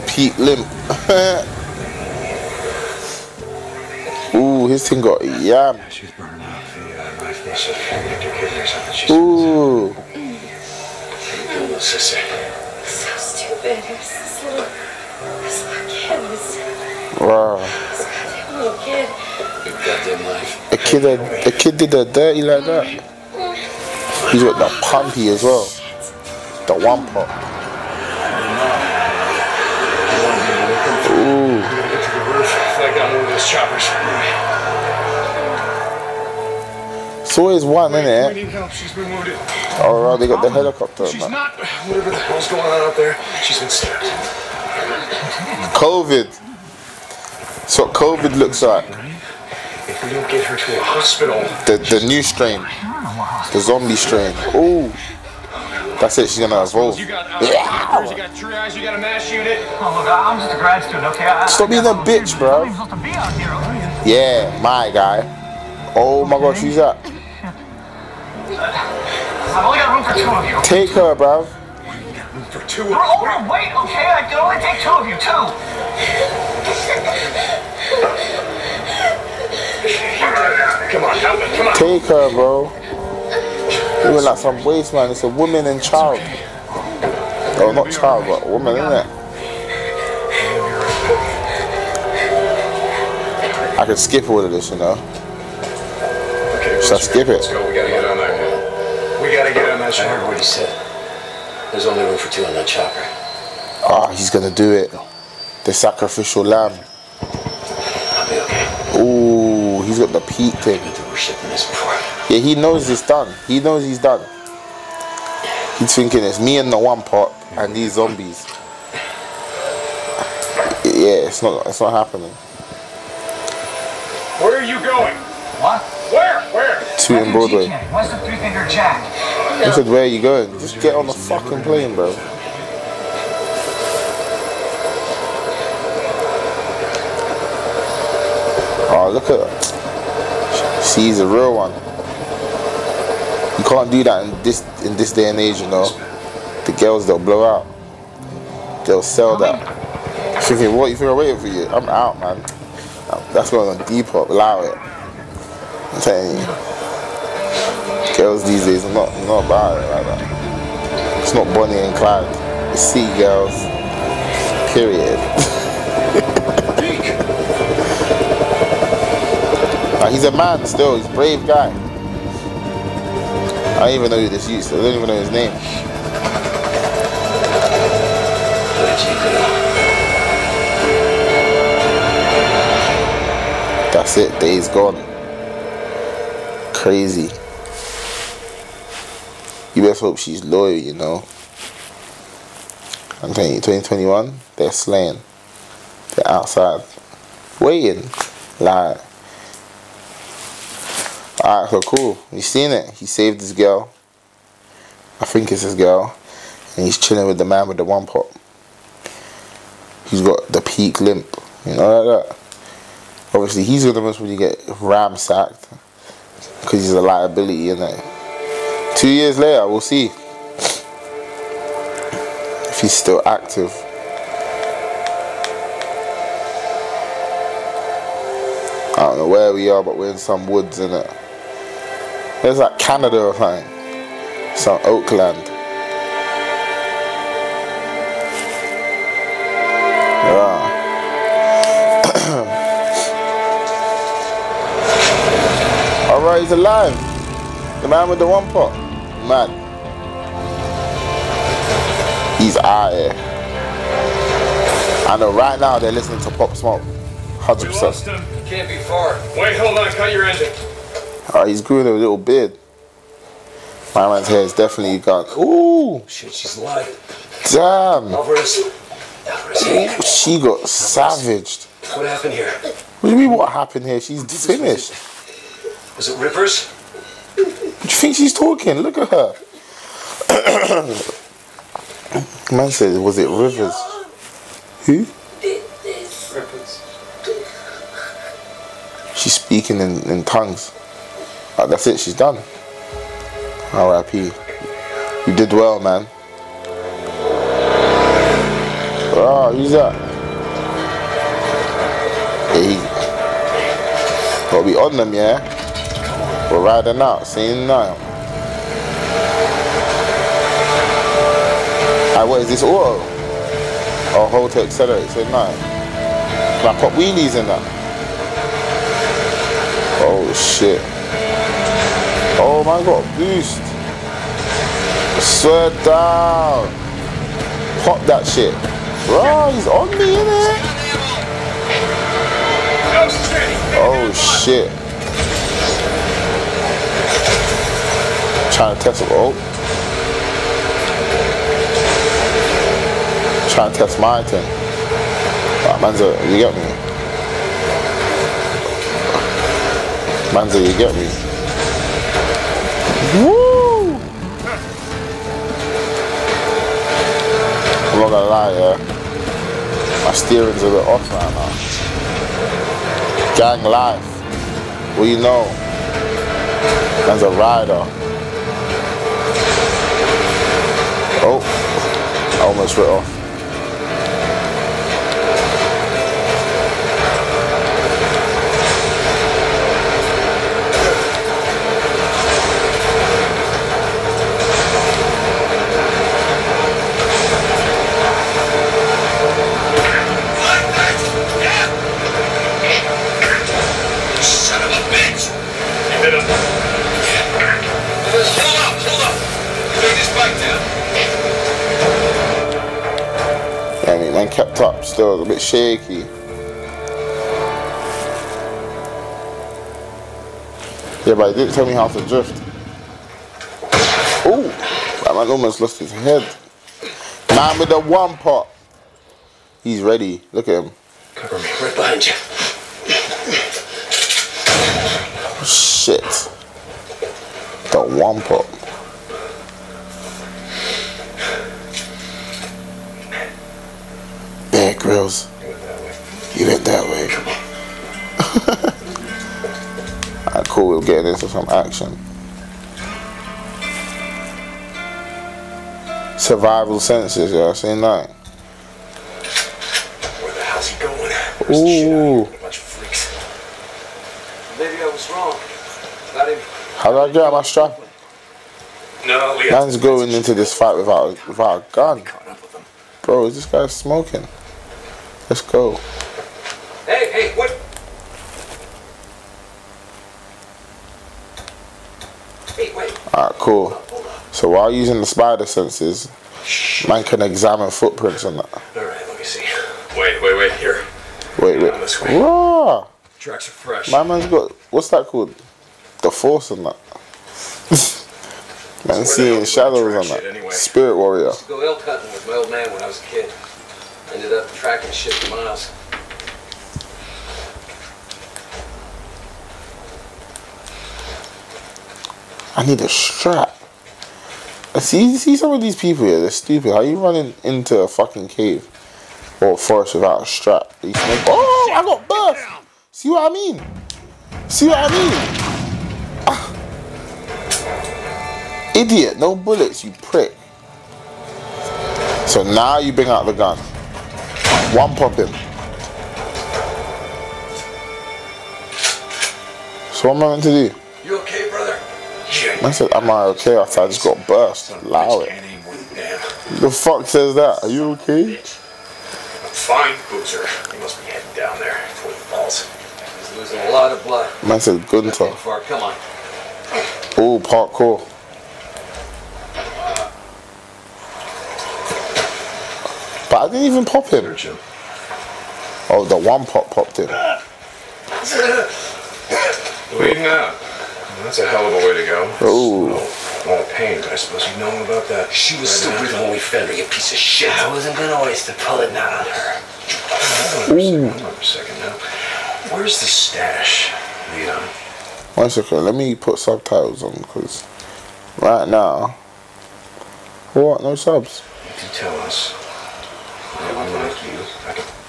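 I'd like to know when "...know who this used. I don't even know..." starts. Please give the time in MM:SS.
02:54.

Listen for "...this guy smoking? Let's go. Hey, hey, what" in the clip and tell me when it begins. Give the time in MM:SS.
07:43.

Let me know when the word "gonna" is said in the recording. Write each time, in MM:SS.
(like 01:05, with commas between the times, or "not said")
00:56, 01:44, 05:58, 09:27.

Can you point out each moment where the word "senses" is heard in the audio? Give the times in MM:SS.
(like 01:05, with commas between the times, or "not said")
07:26, 07:55.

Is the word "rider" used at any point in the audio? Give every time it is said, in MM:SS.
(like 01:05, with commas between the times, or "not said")
06:07.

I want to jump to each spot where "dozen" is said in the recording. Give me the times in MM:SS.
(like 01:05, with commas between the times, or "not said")
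not said.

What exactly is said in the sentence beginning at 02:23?
You can't do that in this in this day and age, you know.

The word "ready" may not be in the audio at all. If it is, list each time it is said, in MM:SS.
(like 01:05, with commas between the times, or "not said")
06:59.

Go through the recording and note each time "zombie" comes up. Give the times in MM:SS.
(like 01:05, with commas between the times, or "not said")
00:53, 01:57.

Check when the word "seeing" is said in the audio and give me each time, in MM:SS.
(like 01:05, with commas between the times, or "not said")
05:07, 08:09.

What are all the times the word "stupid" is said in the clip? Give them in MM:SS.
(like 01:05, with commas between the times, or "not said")
00:11, 08:26.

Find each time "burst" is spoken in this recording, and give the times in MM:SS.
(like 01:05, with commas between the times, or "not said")
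08:32, 08:54.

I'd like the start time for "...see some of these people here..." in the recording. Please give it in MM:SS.
08:25.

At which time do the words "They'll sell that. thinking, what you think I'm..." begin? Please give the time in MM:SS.
02:28.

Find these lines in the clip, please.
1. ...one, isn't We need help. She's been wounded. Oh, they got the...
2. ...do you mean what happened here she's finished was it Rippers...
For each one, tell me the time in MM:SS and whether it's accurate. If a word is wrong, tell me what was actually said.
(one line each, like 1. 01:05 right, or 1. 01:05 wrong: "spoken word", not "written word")
1. 00:37 right
2. 04:33 right.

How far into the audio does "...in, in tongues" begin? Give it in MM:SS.
04:49.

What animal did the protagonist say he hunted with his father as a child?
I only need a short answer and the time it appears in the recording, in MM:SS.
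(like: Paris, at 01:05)
Elk, at 08:11.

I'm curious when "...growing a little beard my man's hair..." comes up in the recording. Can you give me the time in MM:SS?
04:21.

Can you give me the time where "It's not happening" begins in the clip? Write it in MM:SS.
02:01.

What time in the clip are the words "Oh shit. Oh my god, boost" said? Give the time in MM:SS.
05:20.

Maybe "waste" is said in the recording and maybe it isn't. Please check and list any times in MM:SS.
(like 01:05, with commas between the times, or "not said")
01:24, 09:28.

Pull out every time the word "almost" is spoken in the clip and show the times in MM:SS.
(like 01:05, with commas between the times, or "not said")
06:12, 06:55.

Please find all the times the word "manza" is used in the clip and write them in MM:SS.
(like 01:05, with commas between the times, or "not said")
05:45, 05:50.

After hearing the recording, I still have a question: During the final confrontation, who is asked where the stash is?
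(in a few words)
Leon.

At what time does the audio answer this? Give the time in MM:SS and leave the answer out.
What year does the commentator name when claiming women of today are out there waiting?
03:13.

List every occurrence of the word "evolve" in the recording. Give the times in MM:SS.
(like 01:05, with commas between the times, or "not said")
00:56.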